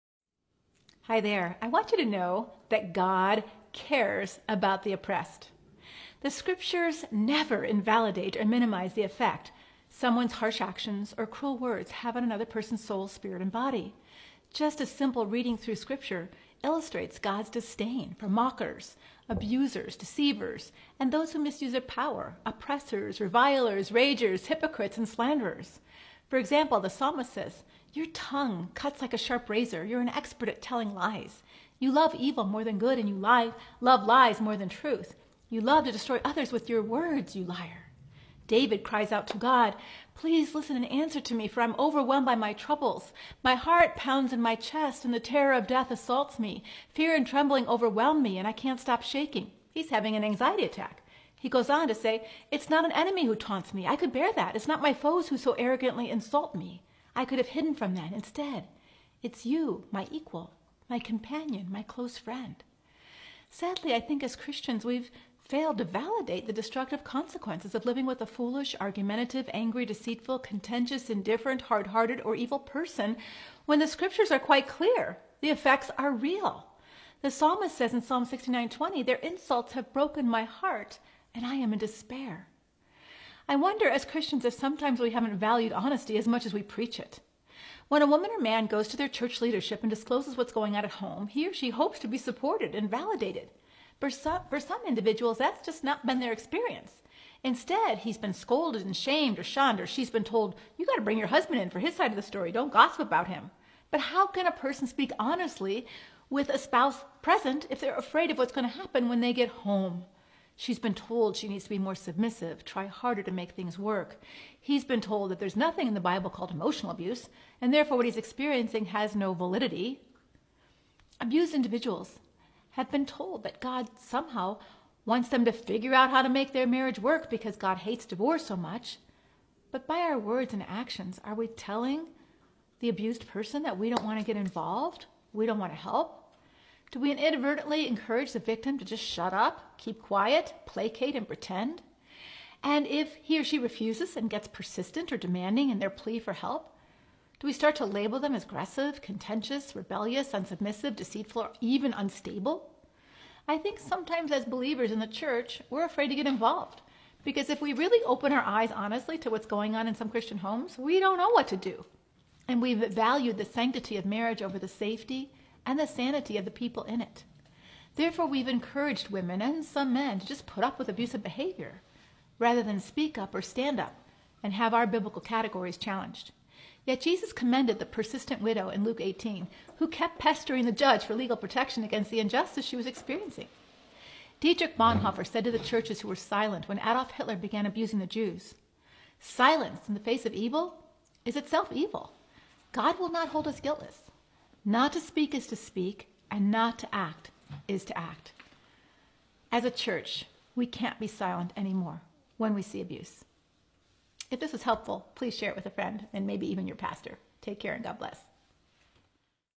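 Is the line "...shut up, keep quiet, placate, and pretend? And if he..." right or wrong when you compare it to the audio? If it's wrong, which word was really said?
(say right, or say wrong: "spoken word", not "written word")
right.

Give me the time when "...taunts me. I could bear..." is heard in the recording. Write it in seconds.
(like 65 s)
53 s.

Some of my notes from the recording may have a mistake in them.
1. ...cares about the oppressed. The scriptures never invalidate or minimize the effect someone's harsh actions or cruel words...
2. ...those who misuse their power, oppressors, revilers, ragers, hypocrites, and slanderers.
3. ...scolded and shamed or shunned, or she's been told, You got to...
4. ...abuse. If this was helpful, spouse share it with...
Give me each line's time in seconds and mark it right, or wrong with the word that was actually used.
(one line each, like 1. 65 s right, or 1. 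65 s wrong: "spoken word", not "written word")
1. 3 s right
2. 21 s right
3. 98 s right
4. 202 s wrong: "please", not "spouse".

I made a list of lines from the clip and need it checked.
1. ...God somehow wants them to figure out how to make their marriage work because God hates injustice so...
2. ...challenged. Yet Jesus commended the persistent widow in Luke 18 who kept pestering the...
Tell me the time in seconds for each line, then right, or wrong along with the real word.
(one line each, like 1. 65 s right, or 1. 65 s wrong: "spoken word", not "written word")
1. 123 s wrong: "divorce", not "injustice"
2. 175 s right.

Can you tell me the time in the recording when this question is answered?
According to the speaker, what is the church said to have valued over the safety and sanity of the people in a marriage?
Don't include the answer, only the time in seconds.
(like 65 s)
163 s.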